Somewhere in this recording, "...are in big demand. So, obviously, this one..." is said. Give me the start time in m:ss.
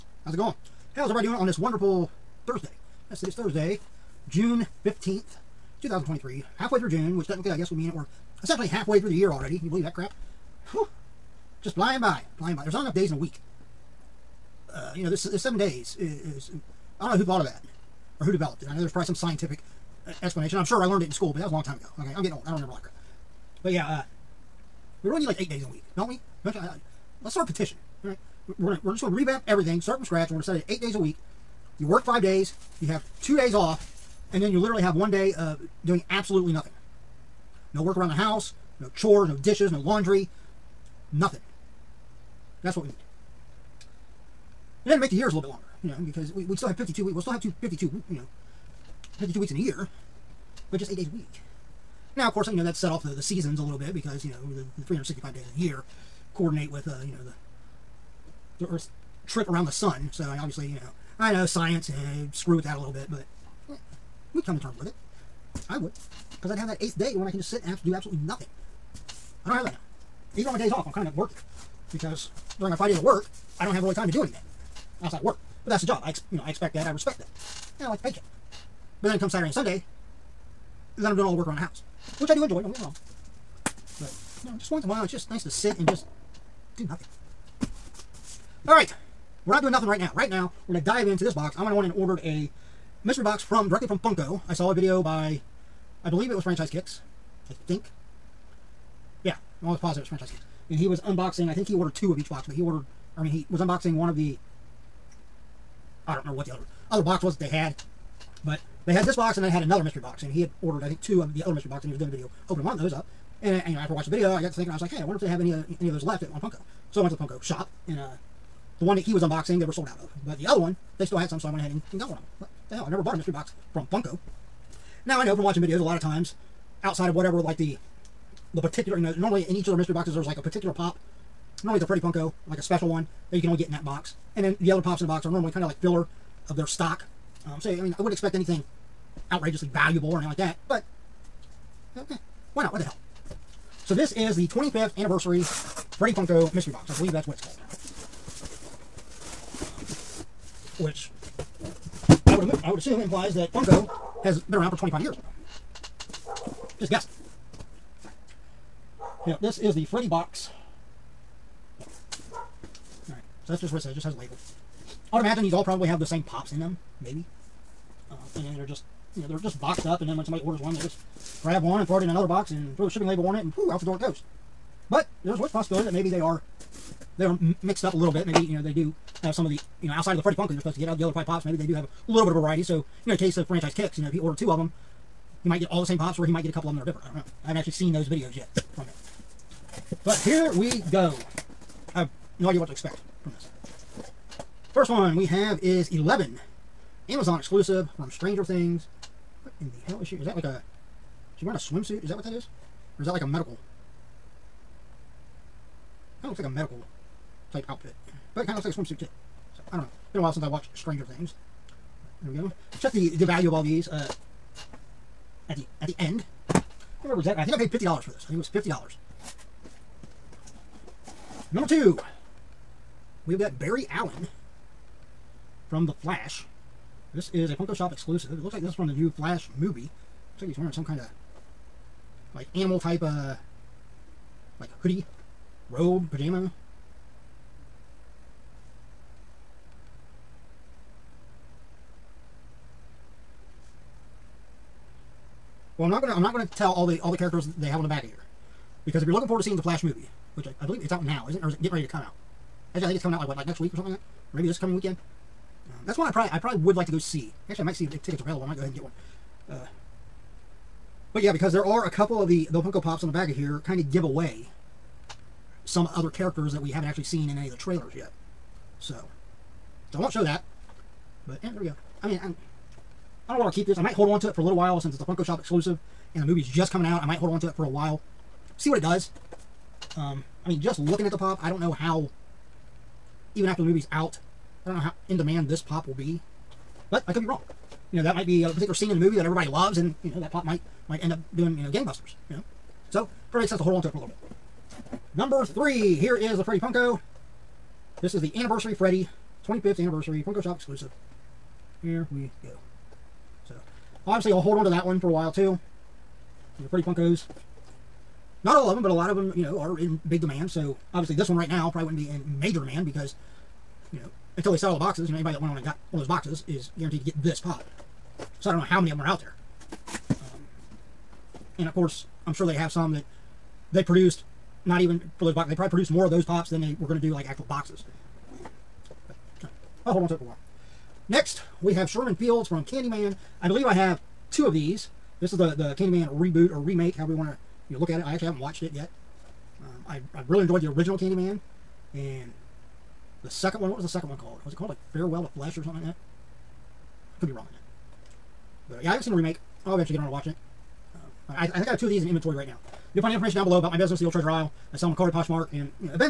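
5:09.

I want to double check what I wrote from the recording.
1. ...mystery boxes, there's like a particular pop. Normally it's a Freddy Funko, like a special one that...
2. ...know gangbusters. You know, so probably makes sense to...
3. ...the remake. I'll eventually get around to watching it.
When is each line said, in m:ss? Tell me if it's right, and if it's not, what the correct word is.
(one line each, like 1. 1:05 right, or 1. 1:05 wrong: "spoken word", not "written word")
1. 2:09 right
2. 4:51 right
3. 5:49 right.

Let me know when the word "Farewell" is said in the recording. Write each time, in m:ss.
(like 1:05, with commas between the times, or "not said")
5:44.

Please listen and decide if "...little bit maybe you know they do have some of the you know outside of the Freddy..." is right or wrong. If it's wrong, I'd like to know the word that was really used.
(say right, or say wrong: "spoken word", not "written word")
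right.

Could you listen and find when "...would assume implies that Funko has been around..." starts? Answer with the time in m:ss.
2:32.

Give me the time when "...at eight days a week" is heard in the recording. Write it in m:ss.
0:30.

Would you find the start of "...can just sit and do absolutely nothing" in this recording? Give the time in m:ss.
1:07.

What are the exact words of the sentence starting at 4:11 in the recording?
Or is it getting ready to come out?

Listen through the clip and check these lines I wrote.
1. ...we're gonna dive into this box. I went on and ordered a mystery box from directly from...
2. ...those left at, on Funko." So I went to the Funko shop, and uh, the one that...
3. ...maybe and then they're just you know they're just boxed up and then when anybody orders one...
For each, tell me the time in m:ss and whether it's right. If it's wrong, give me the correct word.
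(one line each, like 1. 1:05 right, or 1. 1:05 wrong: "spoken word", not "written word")
1. 1:30 right
2. 1:55 right
3. 2:47 wrong: "somebody", not "anybody".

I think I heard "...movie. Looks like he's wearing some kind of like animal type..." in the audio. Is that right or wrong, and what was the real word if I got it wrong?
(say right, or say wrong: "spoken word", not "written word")
right.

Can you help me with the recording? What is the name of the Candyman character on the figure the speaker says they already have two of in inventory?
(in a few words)
Sherman Fields.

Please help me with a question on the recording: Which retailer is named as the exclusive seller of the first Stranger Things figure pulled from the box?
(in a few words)
Amazon.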